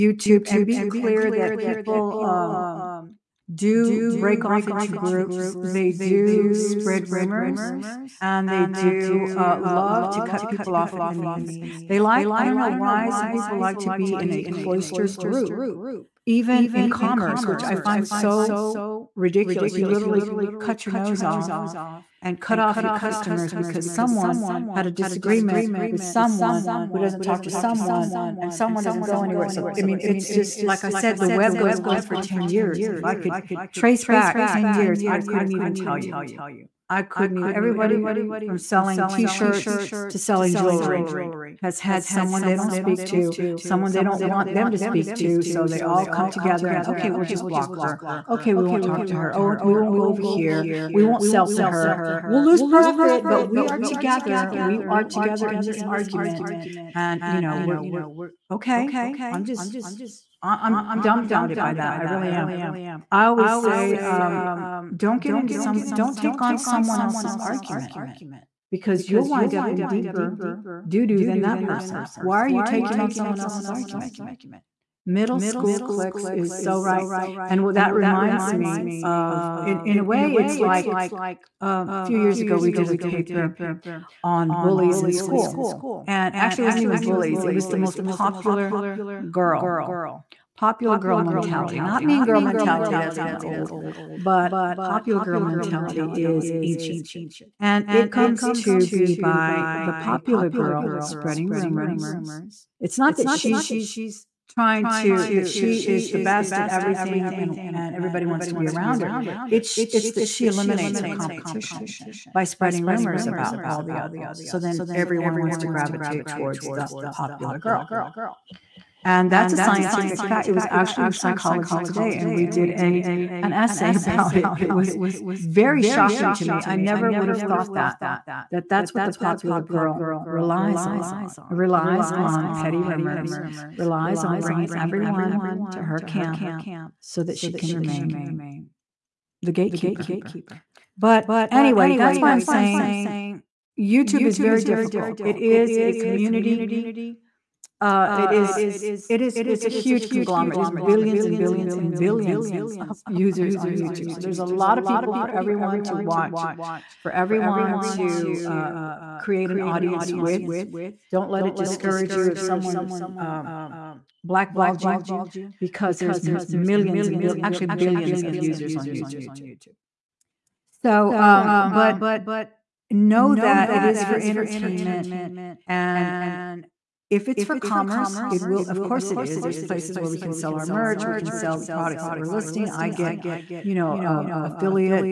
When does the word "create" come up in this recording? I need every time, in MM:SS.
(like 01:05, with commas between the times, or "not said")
02:39.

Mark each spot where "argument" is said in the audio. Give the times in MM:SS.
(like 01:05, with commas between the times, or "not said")
00:55, 01:07, 01:13.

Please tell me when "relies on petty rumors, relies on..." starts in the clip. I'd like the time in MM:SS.
02:11.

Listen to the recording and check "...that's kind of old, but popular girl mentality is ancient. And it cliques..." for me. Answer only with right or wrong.
wrong.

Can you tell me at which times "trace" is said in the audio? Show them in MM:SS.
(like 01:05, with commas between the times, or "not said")
00:33.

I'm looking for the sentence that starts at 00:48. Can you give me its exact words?
Okay, we won't talk to her.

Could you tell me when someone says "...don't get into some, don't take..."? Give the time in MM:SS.
01:04.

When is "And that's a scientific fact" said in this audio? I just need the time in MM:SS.
01:59.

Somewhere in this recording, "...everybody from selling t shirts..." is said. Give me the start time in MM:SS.
00:37.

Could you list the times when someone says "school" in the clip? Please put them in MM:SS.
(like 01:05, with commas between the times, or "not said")
01:15, 01:25.